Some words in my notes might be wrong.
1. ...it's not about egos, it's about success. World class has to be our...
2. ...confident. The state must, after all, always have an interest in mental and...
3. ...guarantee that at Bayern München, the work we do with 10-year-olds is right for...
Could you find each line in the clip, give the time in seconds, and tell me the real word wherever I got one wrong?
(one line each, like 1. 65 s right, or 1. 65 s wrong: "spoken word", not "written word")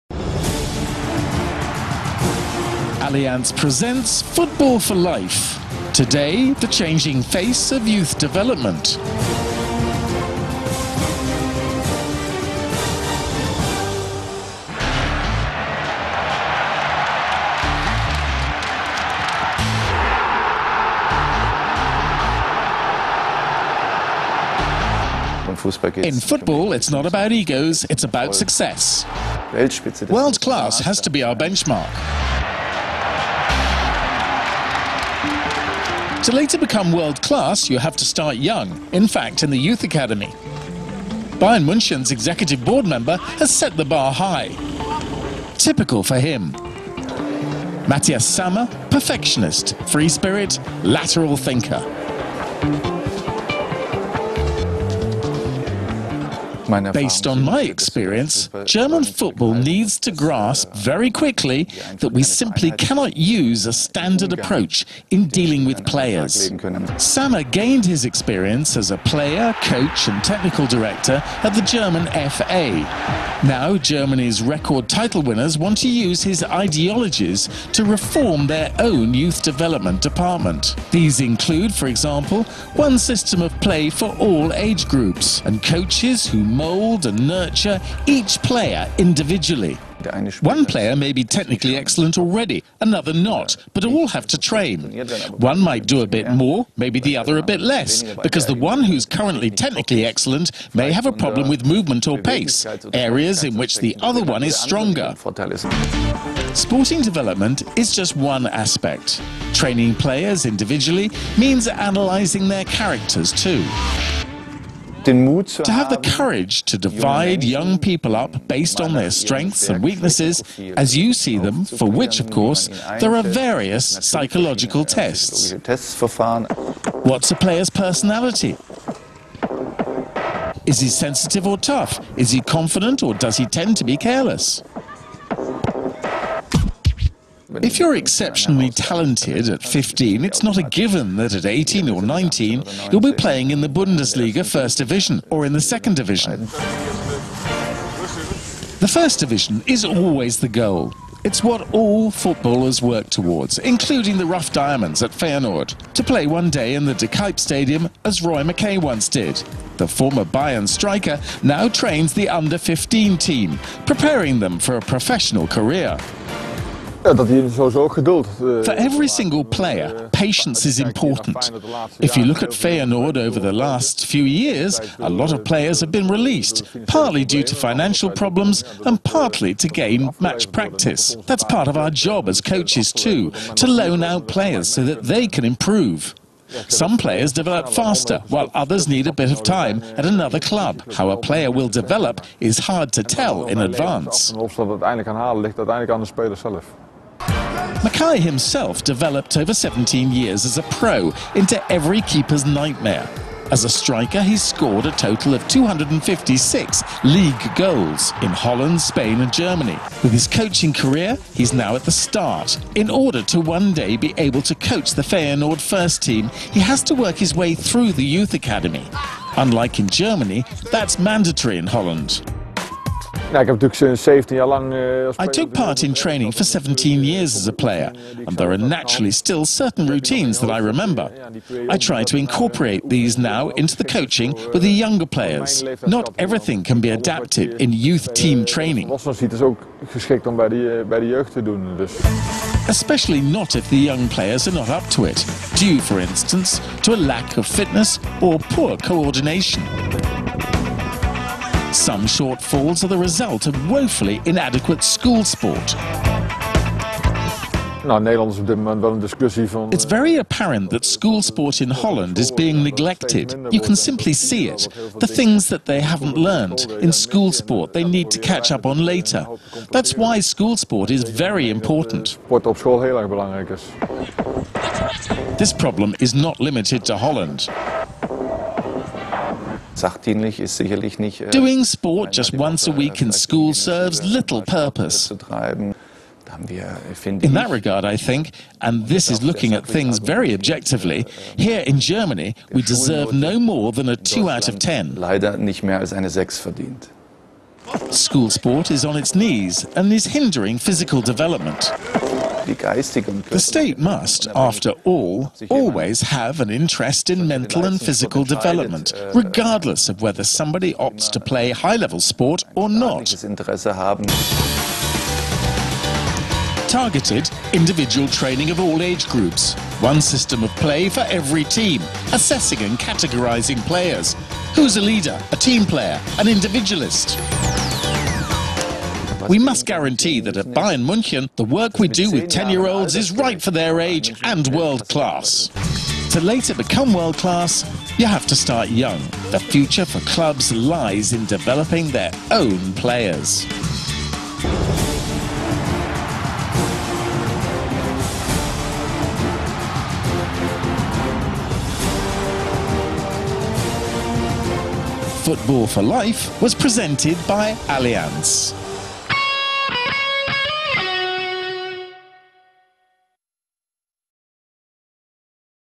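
1. 26 s right
2. 301 s wrong: "development", not "confident"
3. 329 s right.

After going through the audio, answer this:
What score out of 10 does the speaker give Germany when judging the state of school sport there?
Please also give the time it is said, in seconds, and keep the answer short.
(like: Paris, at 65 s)
2, at 293 s.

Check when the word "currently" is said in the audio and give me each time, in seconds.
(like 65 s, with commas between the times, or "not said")
99 s.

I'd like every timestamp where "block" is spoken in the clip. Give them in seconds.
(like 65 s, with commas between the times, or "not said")
not said.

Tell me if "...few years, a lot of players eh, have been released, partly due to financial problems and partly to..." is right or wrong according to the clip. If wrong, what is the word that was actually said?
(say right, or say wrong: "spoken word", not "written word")
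right.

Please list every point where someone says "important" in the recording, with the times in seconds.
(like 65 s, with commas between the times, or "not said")
170 s, 271 s.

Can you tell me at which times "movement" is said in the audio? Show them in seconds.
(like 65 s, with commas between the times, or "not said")
101 s.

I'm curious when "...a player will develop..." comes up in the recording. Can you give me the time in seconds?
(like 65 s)
191 s.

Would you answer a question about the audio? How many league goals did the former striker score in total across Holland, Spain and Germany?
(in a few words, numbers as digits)
256.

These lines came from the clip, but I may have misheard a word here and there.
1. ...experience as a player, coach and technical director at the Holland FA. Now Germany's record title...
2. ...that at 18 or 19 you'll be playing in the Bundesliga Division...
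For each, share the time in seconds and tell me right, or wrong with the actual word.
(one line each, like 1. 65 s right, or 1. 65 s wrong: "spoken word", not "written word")
1. 68 s wrong: "German", not "Holland"
2. 141 s wrong: "First", not "Division".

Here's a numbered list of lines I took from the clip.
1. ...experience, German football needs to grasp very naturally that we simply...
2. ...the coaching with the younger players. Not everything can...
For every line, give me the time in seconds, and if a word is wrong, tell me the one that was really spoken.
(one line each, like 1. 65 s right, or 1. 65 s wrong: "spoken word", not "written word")
1. 57 s wrong: "quickly", not "naturally"
2. 233 s right.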